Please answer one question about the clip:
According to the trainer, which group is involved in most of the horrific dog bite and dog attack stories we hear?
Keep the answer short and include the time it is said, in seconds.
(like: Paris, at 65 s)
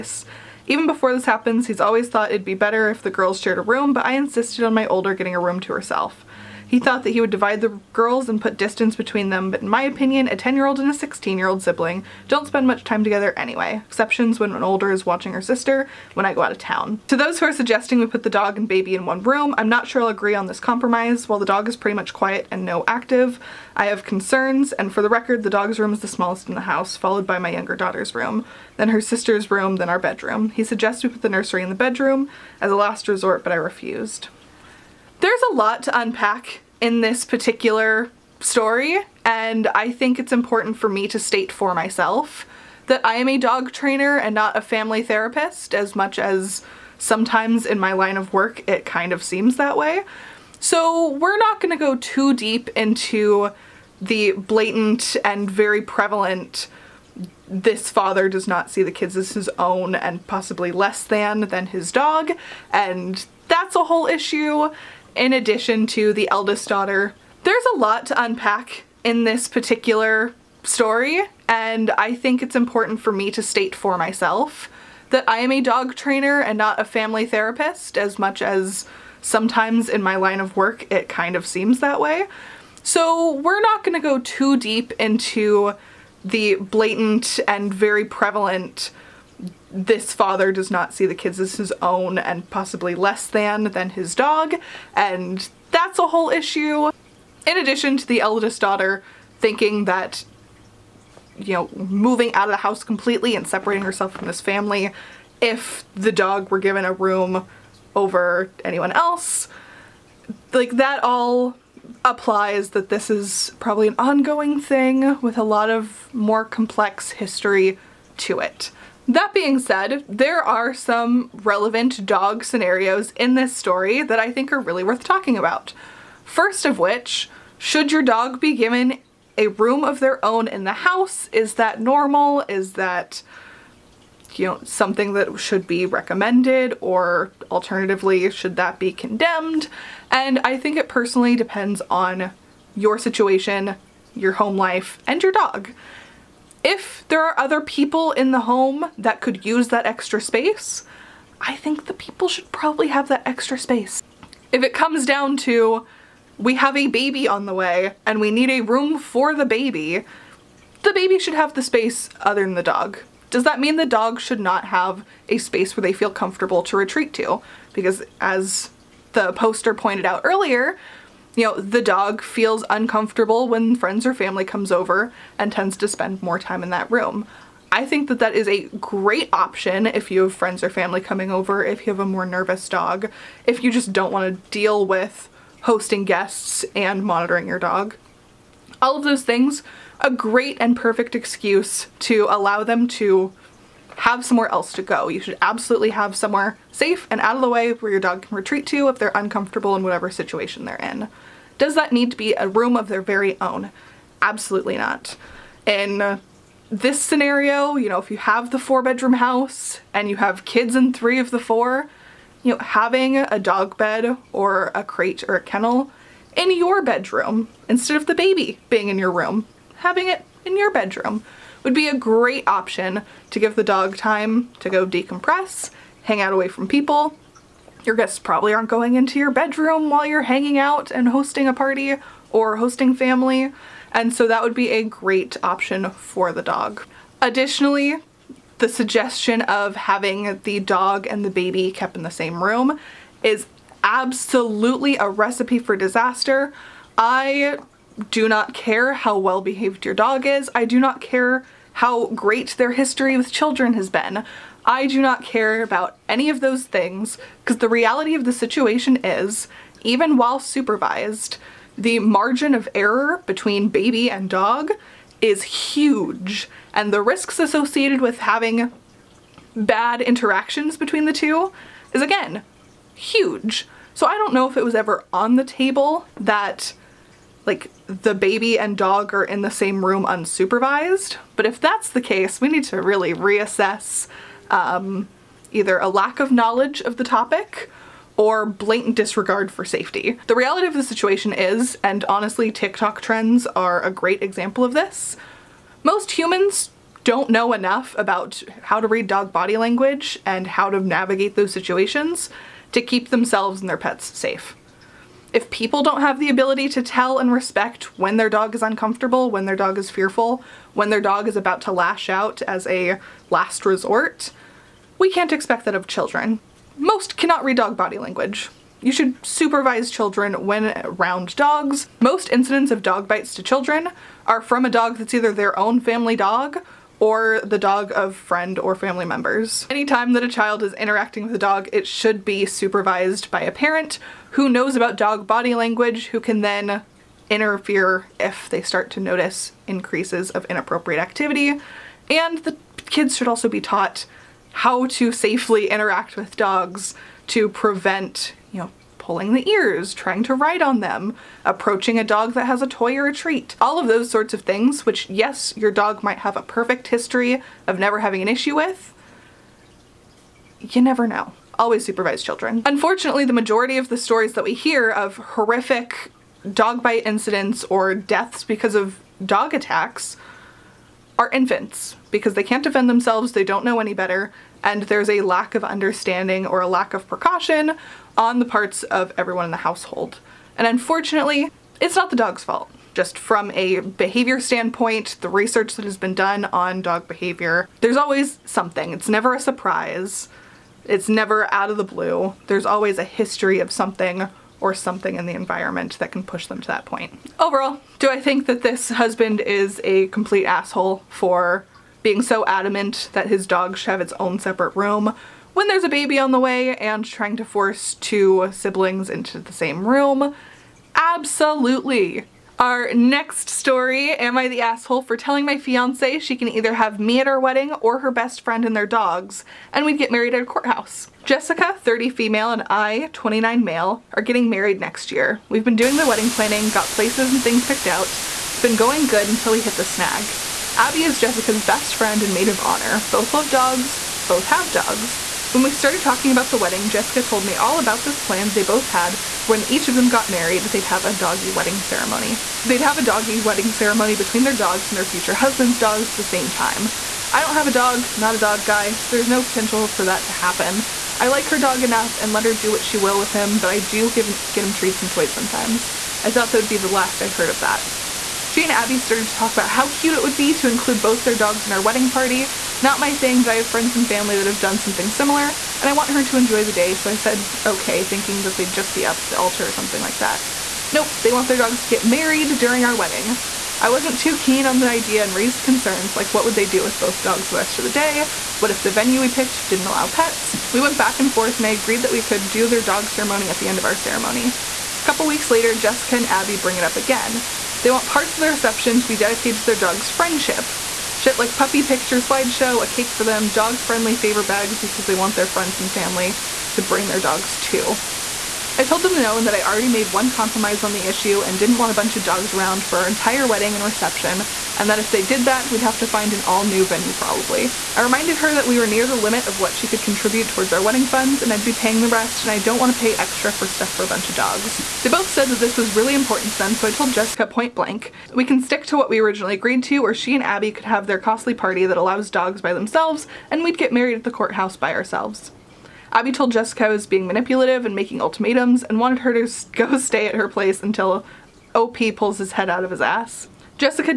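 Infants, at 371 s.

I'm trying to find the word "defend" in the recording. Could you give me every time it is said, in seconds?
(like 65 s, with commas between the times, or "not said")
372 s.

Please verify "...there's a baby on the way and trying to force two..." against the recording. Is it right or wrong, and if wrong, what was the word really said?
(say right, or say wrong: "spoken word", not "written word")
right.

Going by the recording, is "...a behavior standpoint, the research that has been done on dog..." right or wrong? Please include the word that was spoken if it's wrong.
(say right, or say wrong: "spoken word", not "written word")
right.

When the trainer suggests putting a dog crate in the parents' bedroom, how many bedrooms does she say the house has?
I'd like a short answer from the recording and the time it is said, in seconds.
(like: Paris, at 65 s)
4, at 208 s.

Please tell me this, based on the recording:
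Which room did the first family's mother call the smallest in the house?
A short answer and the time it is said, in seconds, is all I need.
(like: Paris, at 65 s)
The dog's room, at 25 s.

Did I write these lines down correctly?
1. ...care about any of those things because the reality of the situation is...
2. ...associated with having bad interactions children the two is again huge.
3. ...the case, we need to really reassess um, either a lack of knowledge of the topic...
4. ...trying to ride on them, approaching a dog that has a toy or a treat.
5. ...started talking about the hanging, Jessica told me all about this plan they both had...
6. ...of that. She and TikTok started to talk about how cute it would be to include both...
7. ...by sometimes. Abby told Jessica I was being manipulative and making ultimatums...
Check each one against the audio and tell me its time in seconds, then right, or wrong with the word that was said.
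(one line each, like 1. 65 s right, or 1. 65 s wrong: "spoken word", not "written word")
1. 255 s right
2. 267 s wrong: "between", not "children"
3. 281 s right
4. 349 s right
5. 435 s wrong: "wedding", not "hanging"
6. 457 s wrong: "Abby", not "TikTok"
7. 524 s wrong: "ourselves", not "sometimes".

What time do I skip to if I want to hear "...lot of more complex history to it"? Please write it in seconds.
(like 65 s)
115 s.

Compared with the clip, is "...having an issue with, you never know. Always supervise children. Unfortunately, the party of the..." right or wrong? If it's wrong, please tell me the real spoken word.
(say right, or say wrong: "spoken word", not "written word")
wrong: "majority", not "party".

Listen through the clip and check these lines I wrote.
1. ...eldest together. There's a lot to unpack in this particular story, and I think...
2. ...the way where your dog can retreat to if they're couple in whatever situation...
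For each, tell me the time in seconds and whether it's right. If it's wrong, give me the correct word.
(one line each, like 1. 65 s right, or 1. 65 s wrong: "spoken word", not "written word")
1. 66 s wrong: "daughter", not "together"
2. 197 s wrong: "uncomfortable", not "couple".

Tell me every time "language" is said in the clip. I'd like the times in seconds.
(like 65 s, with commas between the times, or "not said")
299 s, 317 s, 335 s.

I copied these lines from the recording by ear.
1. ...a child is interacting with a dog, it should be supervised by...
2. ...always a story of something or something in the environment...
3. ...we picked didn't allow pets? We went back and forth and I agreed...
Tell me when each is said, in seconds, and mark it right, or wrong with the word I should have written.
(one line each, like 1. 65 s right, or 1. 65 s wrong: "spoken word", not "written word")
1. 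330 s right
2. 392 s wrong: "history", not "story"
3. 479 s right.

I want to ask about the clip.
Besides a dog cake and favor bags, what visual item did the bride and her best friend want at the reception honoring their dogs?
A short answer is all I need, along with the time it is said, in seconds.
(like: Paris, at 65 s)
Puppy picture slideshow, at 491 s.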